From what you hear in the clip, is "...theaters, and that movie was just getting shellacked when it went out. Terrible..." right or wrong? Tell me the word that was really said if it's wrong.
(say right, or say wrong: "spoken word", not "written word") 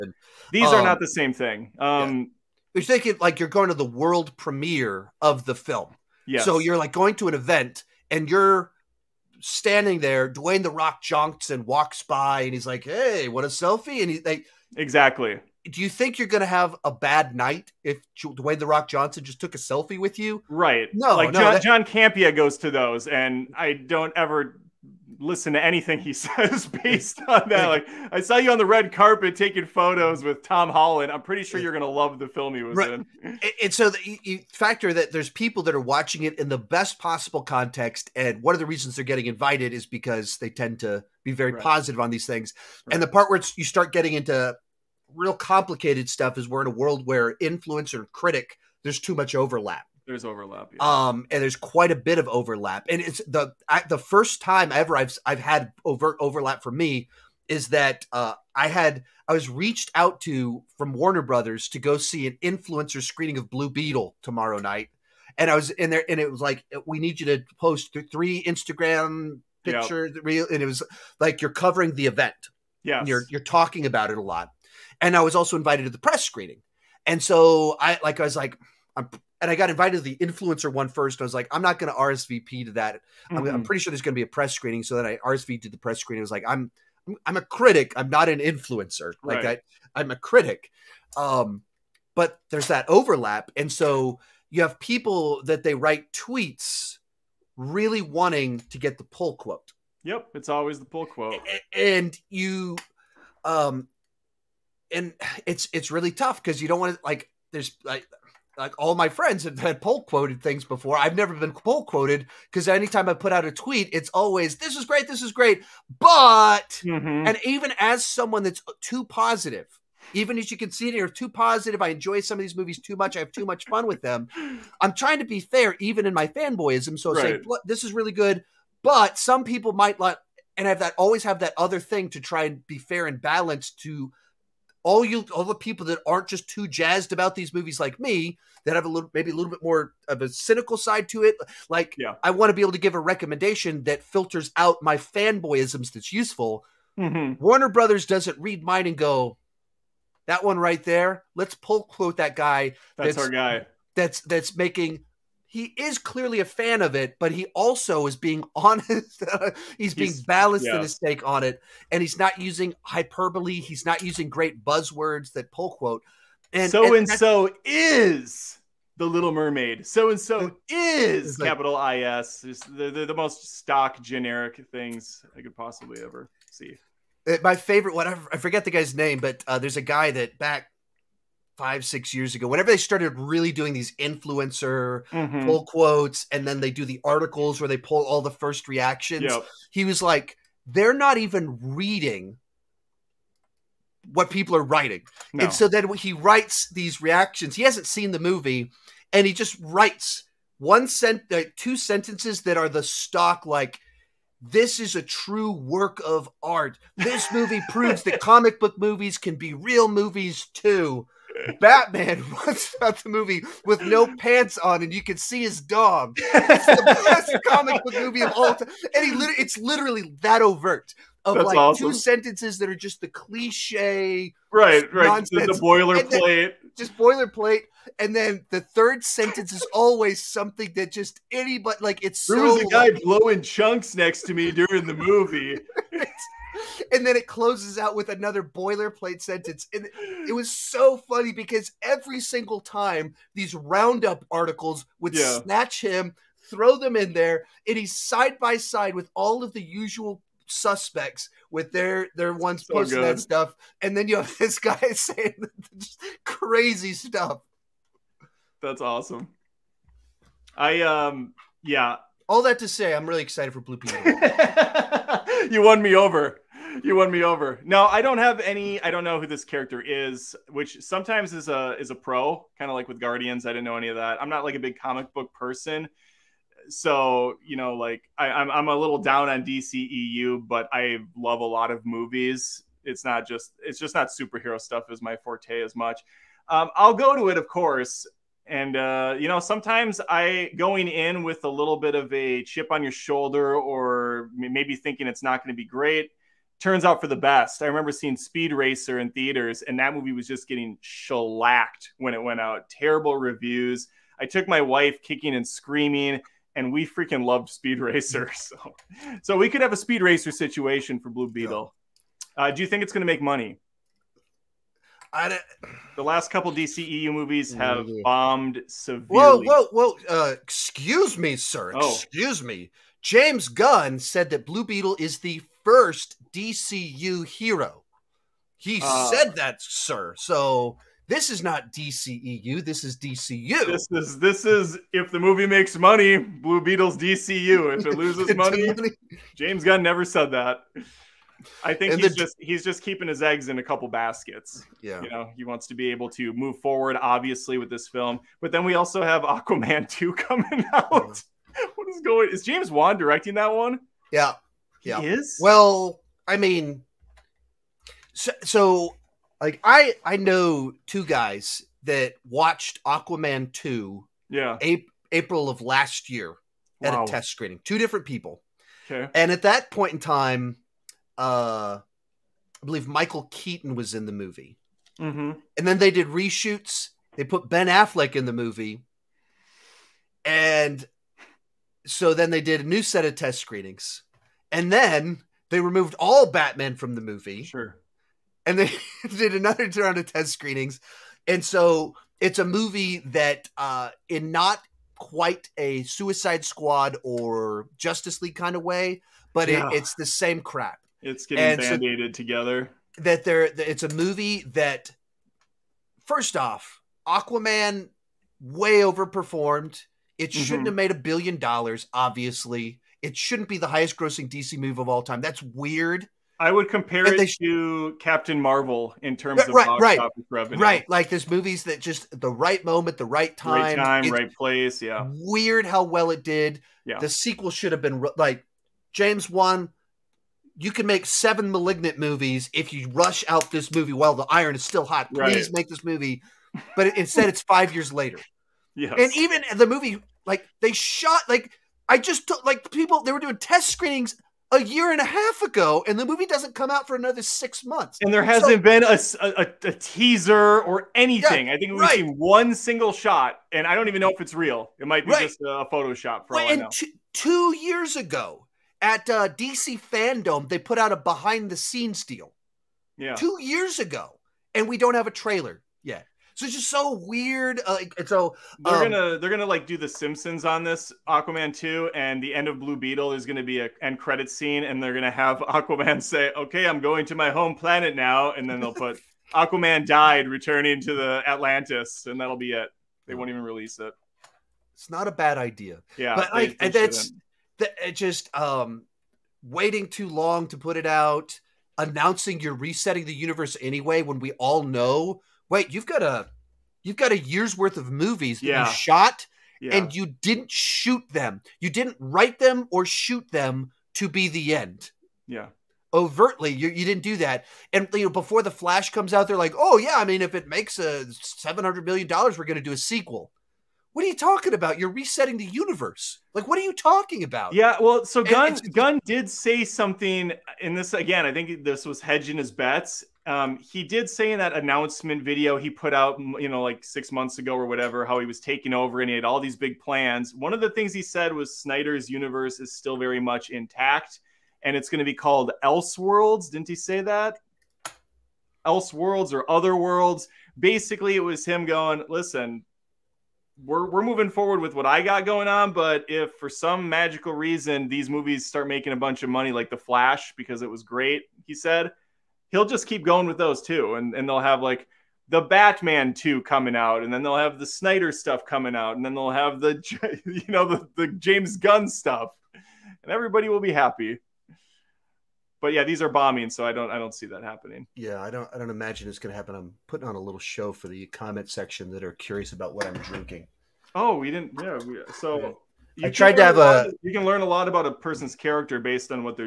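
right.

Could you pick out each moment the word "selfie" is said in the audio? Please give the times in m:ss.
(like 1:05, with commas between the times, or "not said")
0:13, 0:19.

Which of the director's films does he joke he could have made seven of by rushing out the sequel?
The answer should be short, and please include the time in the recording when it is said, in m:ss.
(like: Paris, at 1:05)
Malignant, at 7:11.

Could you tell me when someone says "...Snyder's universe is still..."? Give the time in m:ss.
8:51.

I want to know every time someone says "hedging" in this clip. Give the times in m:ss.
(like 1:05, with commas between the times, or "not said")
8:42.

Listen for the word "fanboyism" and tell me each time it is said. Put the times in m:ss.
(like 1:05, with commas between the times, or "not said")
2:06, 2:24.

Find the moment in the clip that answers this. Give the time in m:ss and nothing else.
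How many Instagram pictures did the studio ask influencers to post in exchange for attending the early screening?
1:08.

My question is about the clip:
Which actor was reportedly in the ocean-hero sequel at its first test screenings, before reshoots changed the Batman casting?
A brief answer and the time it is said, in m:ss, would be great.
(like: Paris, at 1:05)
Michael Keaton, at 6:12.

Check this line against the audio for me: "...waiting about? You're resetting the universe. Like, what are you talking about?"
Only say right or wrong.
wrong.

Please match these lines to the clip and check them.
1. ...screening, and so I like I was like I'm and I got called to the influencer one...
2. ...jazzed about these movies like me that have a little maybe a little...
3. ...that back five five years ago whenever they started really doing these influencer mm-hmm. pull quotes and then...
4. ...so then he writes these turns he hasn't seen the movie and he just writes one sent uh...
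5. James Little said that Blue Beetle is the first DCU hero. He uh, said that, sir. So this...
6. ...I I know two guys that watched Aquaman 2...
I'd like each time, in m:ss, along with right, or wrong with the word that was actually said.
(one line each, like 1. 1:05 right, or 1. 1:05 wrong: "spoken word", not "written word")
1. 1:16 wrong: "invited", not "called"
2. 2:16 right
3. 3:00 wrong: "six", not "five"
4. 3:15 wrong: "reactions", not "turns"
5. 5:23 wrong: "Gunn", not "Little"
6. 5:59 right.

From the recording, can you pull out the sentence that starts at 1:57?
and even as someone that's too positive, even as you can see here, too positive.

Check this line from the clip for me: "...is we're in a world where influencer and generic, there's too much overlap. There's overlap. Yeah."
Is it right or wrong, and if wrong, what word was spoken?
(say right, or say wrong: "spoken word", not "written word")
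wrong: "critic", not "generic".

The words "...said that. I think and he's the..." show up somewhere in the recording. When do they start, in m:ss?
5:40.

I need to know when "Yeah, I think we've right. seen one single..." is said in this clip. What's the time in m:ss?
7:31.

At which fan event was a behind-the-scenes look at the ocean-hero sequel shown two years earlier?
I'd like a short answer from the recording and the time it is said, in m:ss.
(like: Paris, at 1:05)
DC Fandom, at 7:39.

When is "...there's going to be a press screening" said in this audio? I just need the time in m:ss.
1:23.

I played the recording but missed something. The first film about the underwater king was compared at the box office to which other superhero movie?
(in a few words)
Captain Marvel.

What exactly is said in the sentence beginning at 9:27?
Yeah, I don't I don't imagine it's going to happen.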